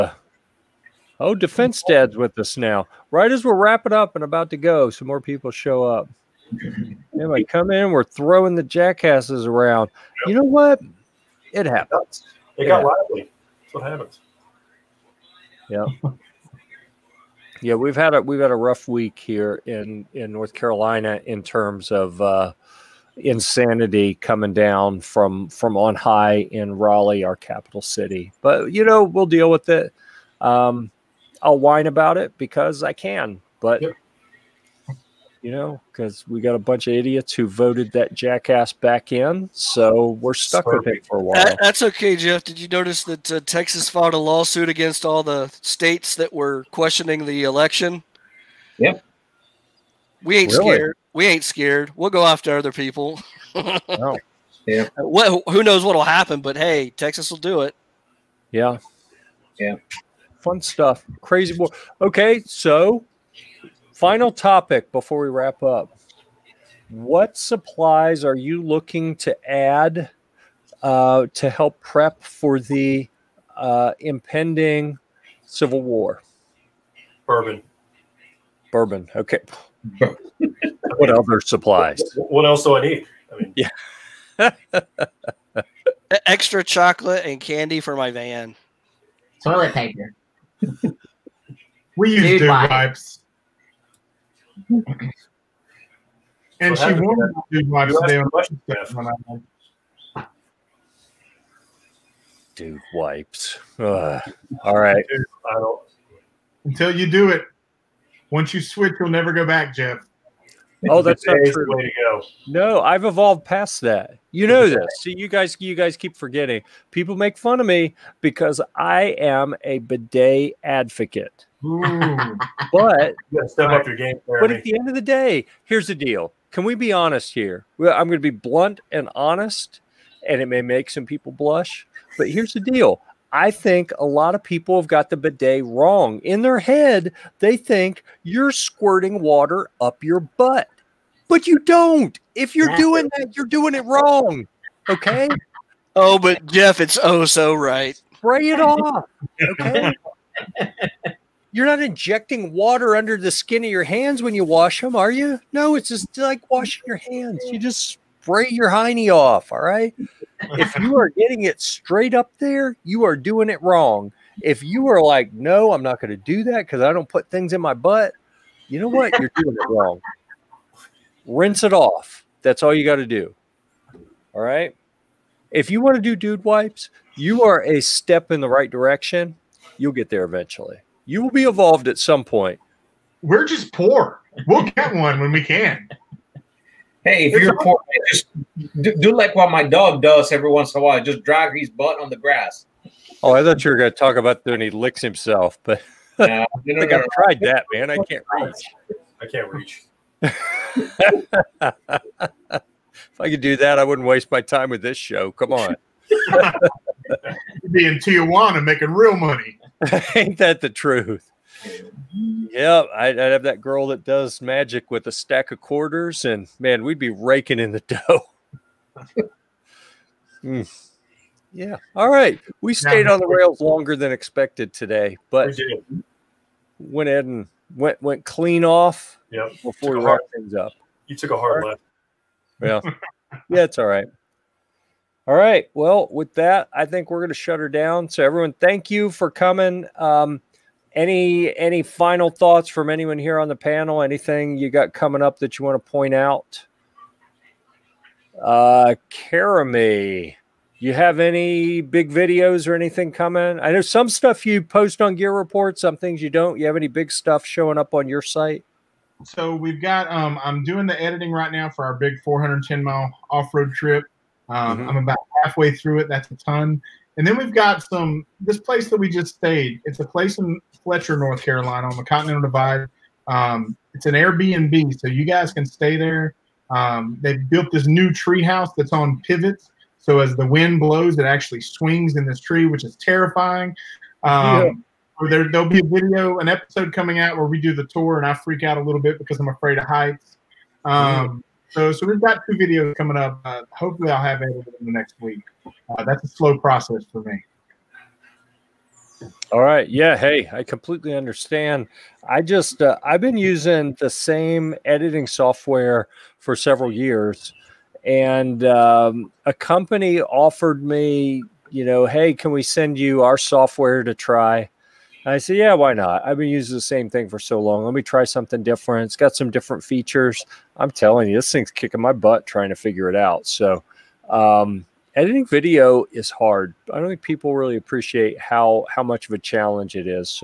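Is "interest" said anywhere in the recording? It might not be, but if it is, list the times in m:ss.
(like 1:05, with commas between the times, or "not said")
not said.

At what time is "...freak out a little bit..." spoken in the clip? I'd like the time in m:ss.
4:48.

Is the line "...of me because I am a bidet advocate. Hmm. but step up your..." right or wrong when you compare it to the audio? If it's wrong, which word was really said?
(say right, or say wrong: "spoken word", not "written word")
right.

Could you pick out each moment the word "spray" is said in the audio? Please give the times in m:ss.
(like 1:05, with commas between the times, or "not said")
2:28, 2:38.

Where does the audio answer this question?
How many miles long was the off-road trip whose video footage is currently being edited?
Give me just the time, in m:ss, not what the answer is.
4:22.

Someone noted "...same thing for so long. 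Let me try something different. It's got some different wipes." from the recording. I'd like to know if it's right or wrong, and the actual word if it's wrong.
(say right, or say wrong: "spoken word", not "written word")
wrong: "features", not "wipes".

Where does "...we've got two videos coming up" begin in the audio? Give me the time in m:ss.
4:52.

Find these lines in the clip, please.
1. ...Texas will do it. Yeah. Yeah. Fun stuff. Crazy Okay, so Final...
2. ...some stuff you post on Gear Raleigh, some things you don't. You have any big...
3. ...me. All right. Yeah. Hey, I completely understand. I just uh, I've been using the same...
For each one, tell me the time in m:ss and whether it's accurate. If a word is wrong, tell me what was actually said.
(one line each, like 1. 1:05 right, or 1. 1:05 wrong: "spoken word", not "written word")
1. 0:56 right
2. 4:13 wrong: "Report", not "Raleigh"
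3. 4:57 right.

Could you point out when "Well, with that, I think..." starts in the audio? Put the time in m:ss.
3:55.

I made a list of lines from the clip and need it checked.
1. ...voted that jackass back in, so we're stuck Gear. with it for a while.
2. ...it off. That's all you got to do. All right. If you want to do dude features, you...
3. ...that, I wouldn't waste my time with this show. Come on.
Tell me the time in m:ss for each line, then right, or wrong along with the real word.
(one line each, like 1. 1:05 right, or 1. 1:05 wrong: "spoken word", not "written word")
1. 0:37 wrong: "Sorry", not "Gear"
2. 2:51 wrong: "wipes", not "features"
3. 3:23 right.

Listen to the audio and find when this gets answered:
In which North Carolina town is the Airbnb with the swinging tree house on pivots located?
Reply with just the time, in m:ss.
4:30.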